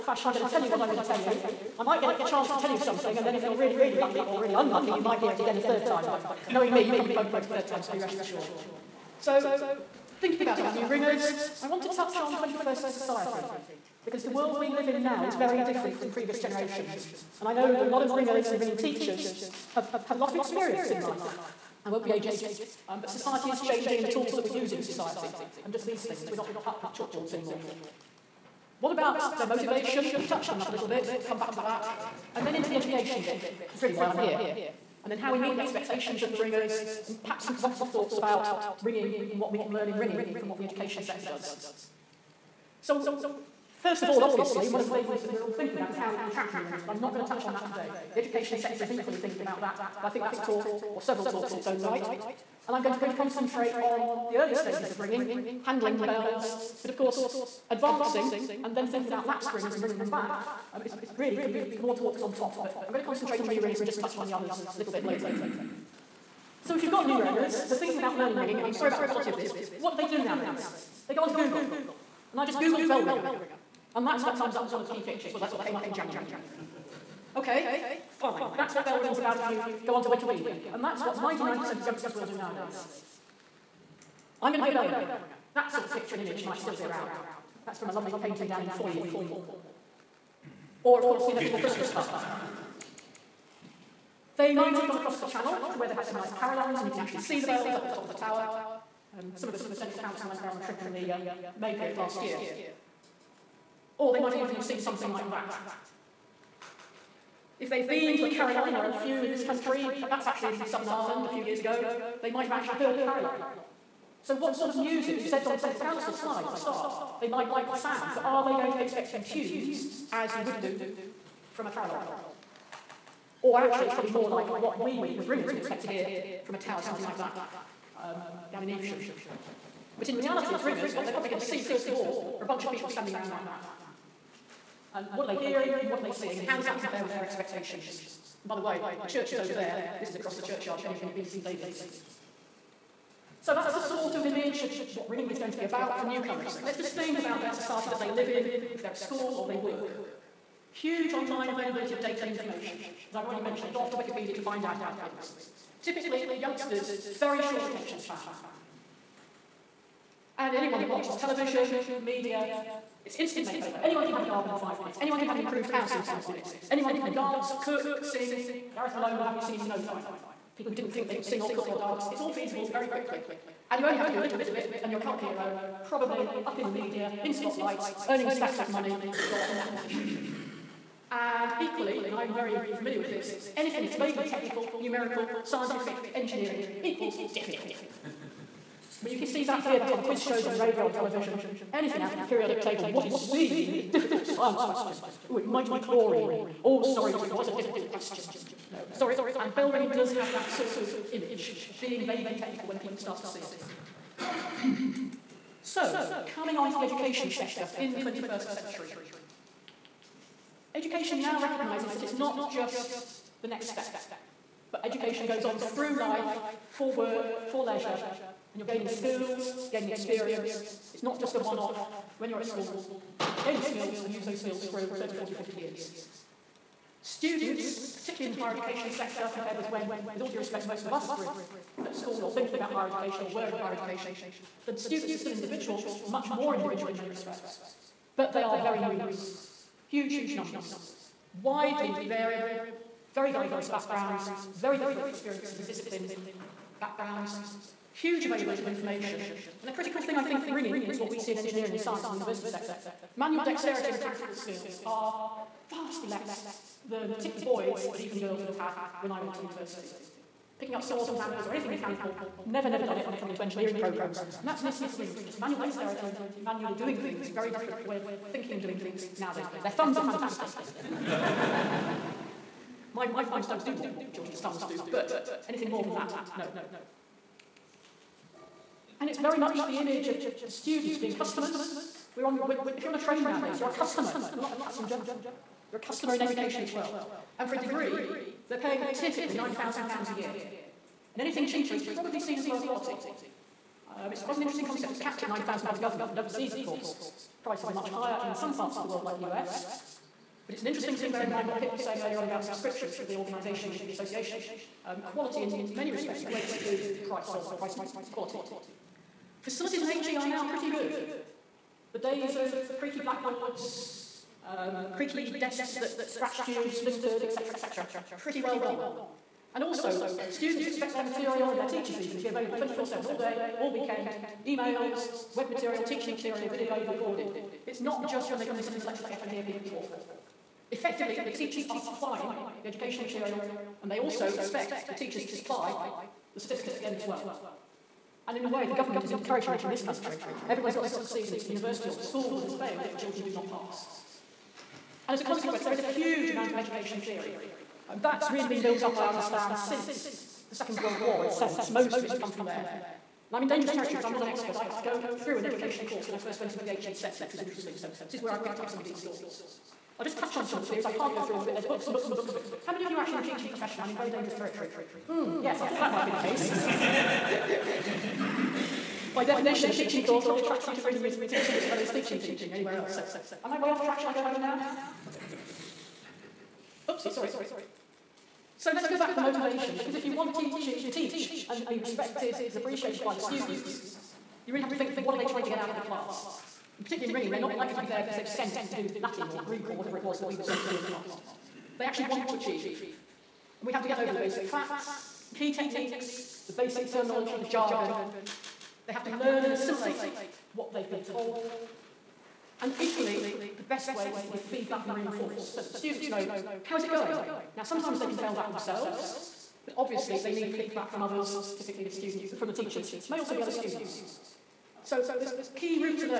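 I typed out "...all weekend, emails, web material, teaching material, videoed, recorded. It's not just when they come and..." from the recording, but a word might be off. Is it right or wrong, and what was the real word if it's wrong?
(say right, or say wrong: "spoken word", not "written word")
right.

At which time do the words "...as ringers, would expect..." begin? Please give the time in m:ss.
2:05.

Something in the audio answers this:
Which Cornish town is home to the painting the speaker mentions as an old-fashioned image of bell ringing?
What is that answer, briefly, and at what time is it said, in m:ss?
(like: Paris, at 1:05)
Fowey, at 1:28.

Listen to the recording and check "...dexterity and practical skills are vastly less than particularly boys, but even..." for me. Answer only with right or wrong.
right.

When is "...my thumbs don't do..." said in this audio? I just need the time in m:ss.
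4:33.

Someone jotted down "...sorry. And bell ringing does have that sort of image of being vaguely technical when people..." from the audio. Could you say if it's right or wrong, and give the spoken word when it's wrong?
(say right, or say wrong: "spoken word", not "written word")
right.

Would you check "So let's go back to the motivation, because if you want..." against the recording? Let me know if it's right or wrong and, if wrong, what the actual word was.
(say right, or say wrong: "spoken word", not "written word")
right.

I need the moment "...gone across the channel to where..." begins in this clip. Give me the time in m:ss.
1:34.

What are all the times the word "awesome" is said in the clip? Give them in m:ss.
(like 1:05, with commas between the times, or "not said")
not said.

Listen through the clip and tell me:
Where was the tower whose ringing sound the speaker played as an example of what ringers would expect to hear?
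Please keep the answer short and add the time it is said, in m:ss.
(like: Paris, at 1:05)
Evesham, at 2:08.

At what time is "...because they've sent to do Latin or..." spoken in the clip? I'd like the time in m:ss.
6:28.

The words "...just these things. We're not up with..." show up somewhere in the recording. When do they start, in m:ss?
0:25.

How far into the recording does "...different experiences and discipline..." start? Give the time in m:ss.
4:04.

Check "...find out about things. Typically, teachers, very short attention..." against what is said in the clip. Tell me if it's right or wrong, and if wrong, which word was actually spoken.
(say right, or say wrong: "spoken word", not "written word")
wrong: "youngsters", not "teachers".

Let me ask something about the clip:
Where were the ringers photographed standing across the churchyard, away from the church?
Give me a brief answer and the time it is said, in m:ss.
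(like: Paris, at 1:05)
St David's, at 2:21.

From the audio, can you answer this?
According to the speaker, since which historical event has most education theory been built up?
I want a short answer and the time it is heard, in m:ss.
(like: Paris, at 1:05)
Second World War, at 5:50.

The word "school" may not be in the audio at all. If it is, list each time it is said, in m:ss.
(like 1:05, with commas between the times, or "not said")
2:28, 3:42, 3:51, 5:42.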